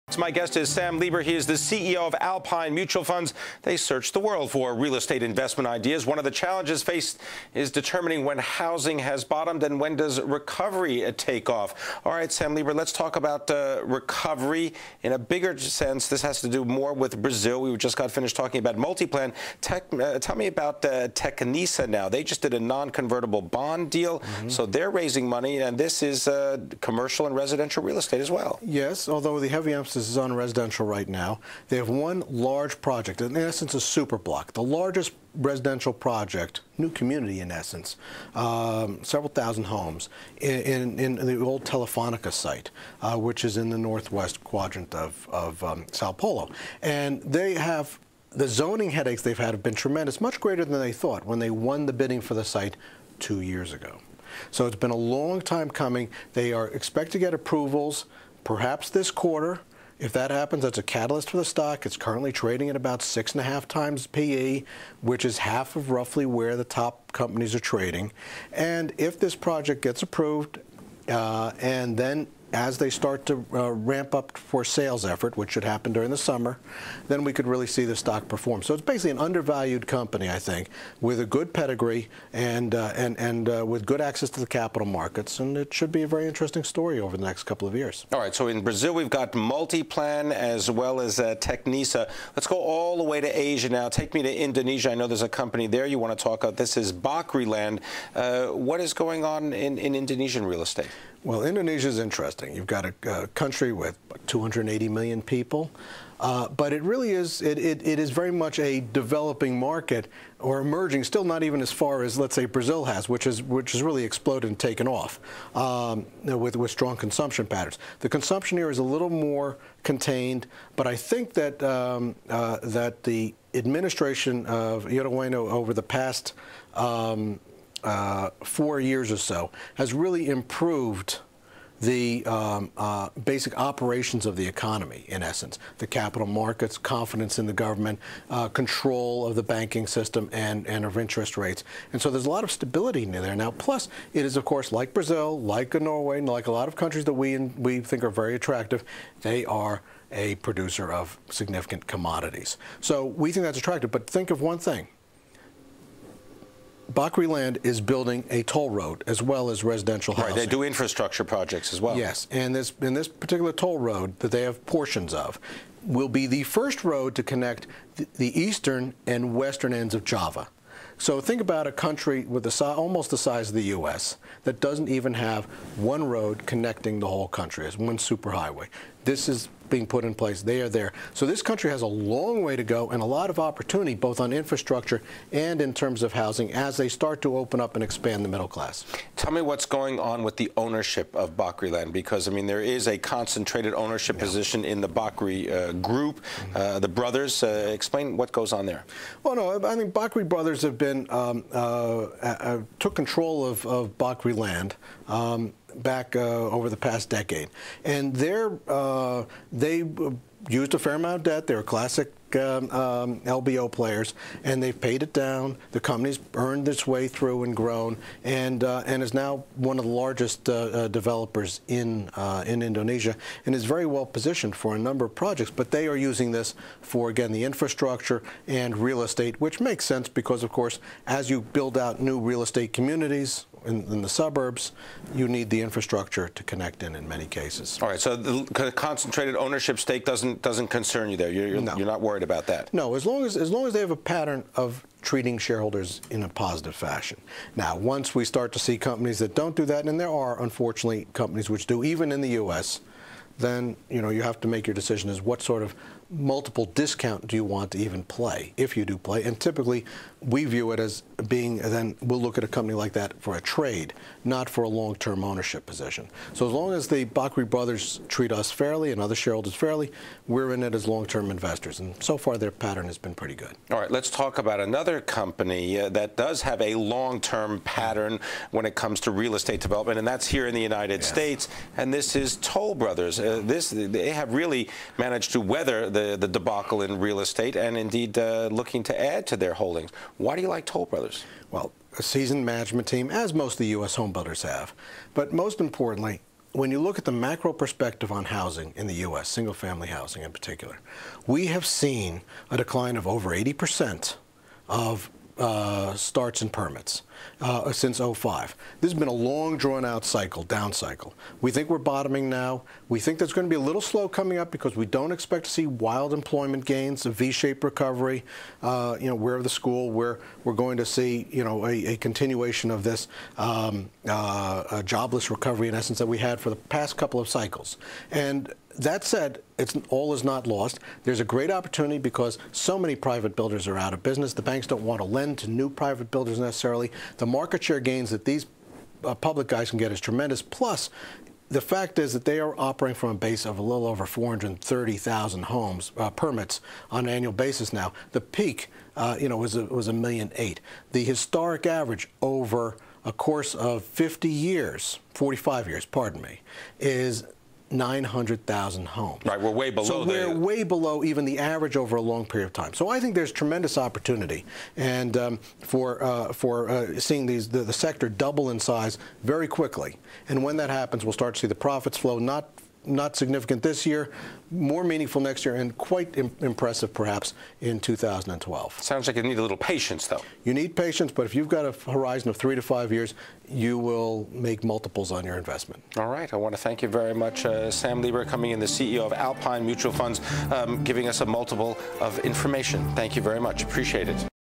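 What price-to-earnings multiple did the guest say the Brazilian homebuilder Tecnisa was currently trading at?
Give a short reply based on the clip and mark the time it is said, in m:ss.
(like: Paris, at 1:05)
6.5, at 1:03.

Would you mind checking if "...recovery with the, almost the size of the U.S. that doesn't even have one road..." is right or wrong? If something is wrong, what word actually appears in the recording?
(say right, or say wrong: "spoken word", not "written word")
wrong: "country", not "recovery".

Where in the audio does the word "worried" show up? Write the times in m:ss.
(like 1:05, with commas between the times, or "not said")
4:02.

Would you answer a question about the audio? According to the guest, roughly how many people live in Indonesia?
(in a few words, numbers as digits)
280 million.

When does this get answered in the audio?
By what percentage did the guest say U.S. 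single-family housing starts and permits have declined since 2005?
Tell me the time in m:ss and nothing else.
5:03.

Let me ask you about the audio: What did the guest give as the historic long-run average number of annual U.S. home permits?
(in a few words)
900,000.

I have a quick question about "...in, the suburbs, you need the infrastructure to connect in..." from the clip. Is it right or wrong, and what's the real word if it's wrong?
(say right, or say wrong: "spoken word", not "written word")
right.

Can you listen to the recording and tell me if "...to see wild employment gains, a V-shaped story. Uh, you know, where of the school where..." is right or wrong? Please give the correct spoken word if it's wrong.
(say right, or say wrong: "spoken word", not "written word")
wrong: "recovery", not "story".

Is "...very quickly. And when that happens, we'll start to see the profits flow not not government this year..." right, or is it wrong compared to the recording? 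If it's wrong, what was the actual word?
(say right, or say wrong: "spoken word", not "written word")
wrong: "significant", not "government".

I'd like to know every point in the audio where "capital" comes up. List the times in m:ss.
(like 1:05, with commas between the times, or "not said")
1:24, 2:15.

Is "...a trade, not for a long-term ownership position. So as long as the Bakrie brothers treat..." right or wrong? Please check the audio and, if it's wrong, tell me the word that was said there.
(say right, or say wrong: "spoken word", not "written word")
right.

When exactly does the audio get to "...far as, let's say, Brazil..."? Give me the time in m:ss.
1:51.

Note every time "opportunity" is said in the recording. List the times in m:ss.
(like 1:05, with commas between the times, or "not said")
3:03, 5:31, 6:03.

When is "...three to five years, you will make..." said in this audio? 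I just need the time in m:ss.
6:22.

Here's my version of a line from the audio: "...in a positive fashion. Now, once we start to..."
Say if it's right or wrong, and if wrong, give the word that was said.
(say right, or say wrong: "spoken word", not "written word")
right.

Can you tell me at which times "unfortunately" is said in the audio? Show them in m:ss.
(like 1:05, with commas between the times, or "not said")
4:10.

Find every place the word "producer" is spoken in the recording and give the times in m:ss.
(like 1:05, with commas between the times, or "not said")
2:30.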